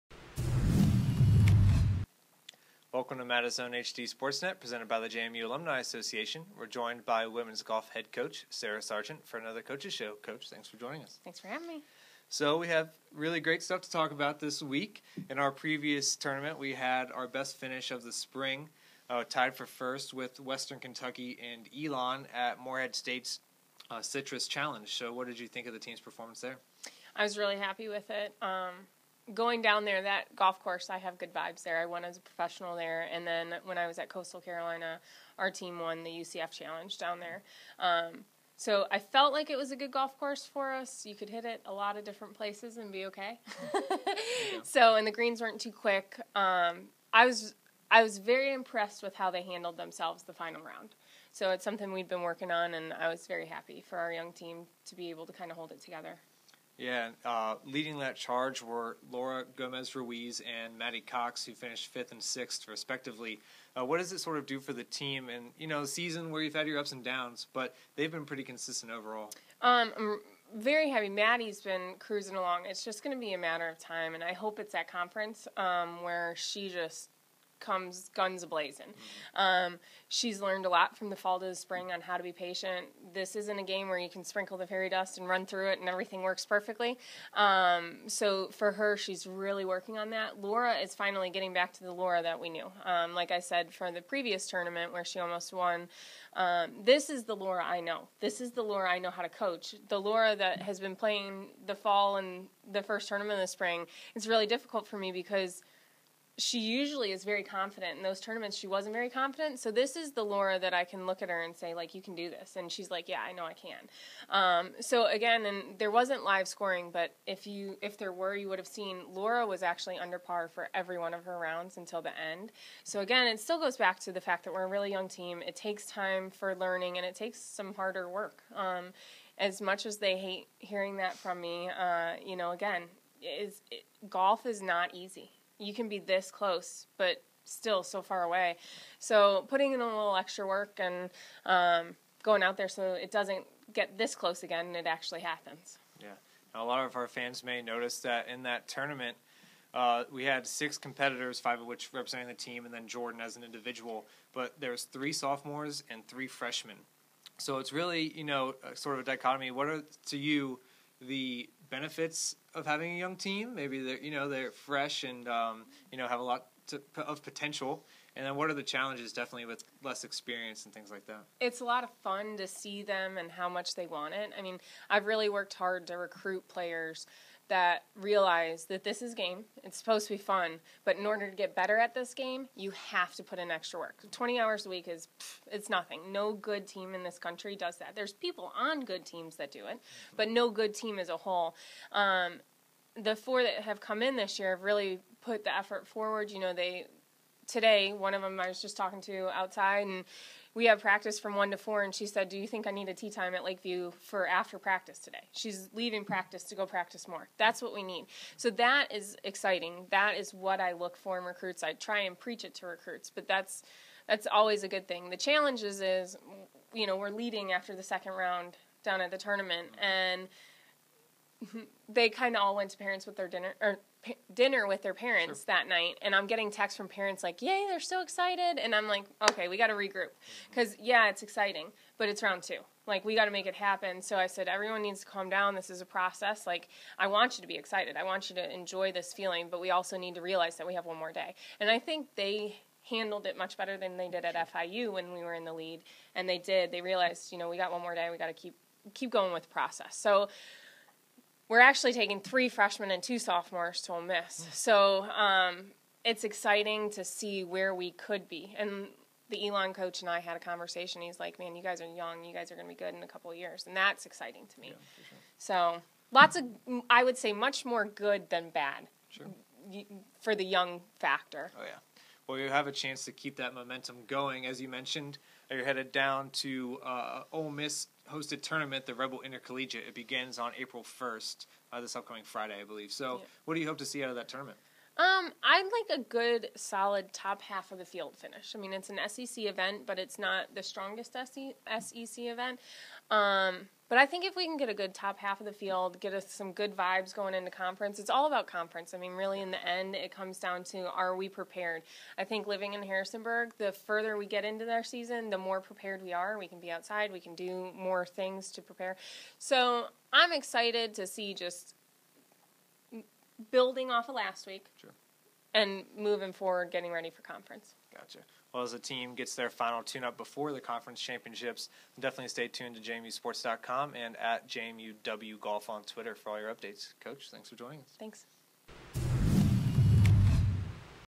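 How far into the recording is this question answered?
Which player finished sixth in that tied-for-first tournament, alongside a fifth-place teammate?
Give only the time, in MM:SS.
01:00.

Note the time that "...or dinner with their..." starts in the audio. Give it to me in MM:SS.
03:43.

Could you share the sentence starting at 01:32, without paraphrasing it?
Um, like I said, from the previous tournament where she almost won, um, this is the Laura I know.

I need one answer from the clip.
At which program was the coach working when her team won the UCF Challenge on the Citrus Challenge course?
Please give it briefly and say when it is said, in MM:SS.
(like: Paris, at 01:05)
Coastal Carolina, at 00:34.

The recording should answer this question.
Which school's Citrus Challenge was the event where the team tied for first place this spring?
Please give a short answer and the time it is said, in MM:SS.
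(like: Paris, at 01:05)
Morehead State, at 00:22.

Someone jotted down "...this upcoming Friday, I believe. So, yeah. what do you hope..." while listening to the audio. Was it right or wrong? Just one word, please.
right.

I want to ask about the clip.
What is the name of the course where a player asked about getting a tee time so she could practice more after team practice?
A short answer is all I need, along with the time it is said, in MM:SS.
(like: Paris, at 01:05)
Lakeview, at 03:23.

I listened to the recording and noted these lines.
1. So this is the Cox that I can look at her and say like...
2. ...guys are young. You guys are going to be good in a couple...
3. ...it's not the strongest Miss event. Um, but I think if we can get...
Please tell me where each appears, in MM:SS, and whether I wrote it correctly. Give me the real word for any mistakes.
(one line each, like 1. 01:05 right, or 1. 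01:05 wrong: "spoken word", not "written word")
1. 01:49 wrong: "Laura", not "Cox"
2. 04:21 right
3. 04:49 wrong: "SEC", not "Miss".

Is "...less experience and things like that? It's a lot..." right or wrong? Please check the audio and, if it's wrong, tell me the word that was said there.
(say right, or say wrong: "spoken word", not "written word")
right.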